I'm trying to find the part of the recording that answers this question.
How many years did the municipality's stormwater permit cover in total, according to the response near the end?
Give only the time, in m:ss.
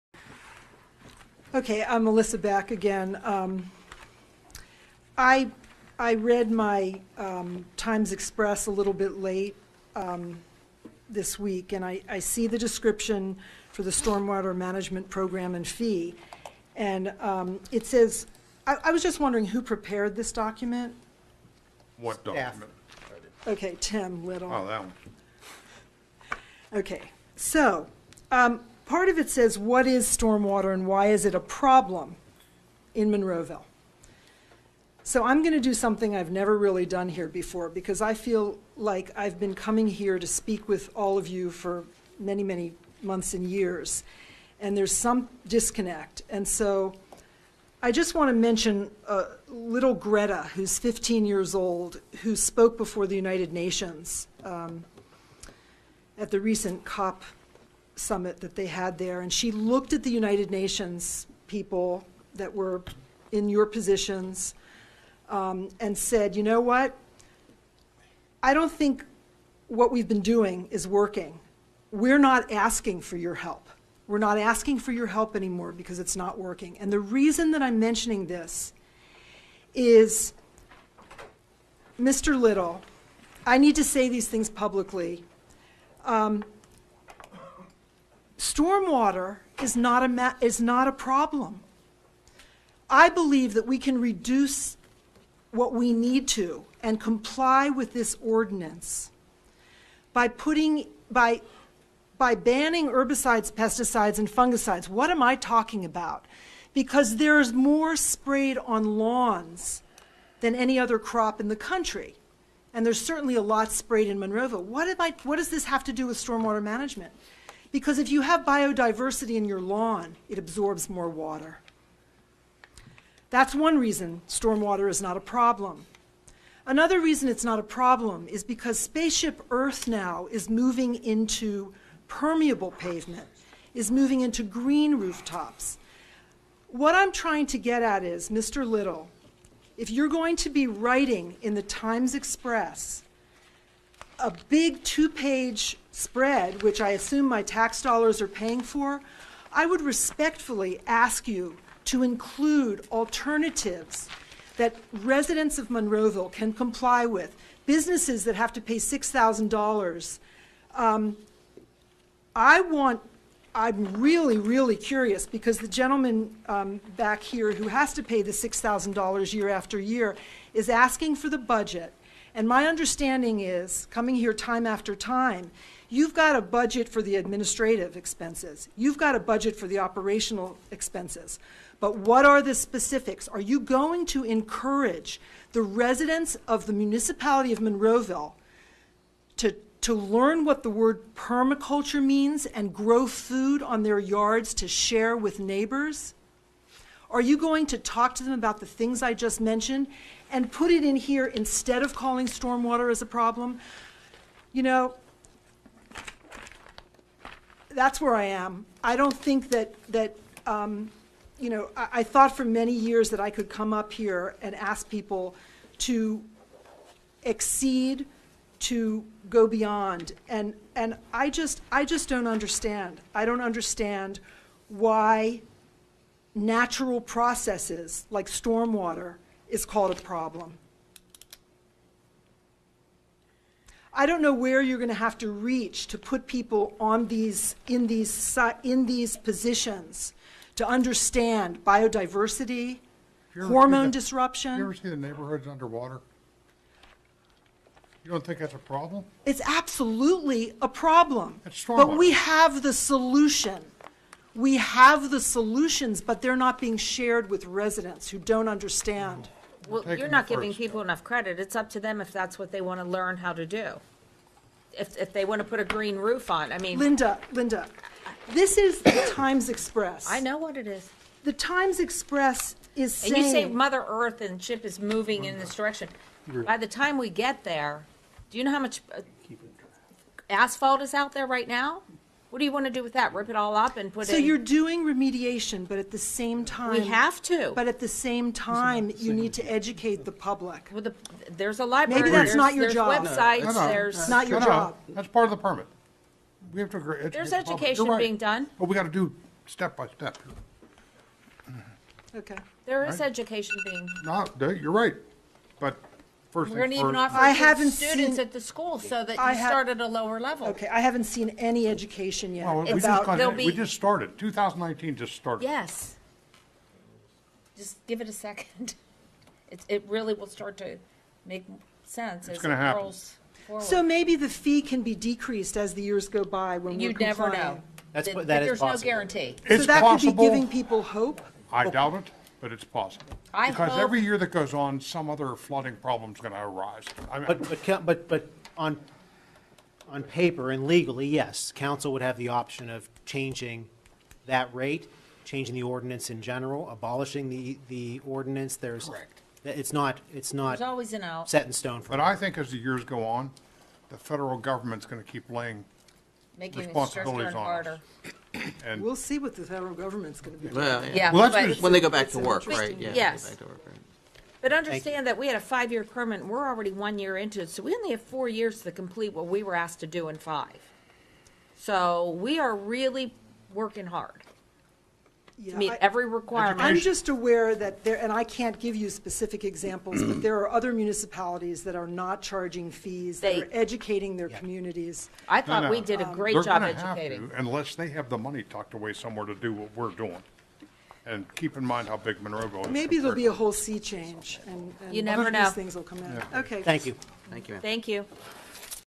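6:05.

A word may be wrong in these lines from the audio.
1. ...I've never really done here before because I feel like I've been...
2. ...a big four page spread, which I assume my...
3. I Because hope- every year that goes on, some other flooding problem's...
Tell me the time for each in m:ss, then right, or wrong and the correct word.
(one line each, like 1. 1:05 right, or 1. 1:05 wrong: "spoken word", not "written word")
1. 0:36 right
2. 2:24 wrong: "two", not "four"
3. 5:33 right.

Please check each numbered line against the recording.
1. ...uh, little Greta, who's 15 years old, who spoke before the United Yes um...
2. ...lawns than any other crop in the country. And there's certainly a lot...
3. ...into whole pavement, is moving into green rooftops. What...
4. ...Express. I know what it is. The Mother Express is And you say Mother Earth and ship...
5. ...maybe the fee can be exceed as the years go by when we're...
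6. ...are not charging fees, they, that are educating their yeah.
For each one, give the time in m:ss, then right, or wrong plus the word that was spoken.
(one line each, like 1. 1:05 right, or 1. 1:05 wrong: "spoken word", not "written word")
1. 0:49 wrong: "Nations", not "Yes"
2. 1:48 right
3. 2:10 wrong: "permeable", not "whole"
4. 4:29 wrong: "Times", not "Mother"
5. 5:23 wrong: "decreased", not "exceed"
6. 6:21 right.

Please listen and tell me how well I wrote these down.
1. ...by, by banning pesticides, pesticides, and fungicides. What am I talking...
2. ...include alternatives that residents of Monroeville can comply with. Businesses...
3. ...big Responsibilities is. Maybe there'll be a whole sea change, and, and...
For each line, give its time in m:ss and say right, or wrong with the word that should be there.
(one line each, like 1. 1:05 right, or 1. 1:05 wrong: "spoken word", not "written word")
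1. 1:41 wrong: "herbicides", not "pesticides"
2. 2:32 right
3. 6:31 wrong: "Monroeville", not "Responsibilities".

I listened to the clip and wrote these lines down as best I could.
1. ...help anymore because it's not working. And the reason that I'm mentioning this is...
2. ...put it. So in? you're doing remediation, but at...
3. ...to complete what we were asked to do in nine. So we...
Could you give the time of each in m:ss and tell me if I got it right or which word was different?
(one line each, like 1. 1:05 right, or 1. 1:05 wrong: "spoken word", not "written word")
1. 1:15 right
2. 4:43 right
3. 6:08 wrong: "five", not "nine".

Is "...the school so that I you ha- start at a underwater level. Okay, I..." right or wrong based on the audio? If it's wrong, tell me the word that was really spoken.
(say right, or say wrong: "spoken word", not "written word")
wrong: "lower", not "underwater".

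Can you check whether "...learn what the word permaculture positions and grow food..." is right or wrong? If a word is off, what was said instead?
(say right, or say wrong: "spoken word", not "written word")
wrong: "means", not "positions".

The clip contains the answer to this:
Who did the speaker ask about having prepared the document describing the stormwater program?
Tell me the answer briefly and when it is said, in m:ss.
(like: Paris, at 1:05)
Tim Little, at 0:23.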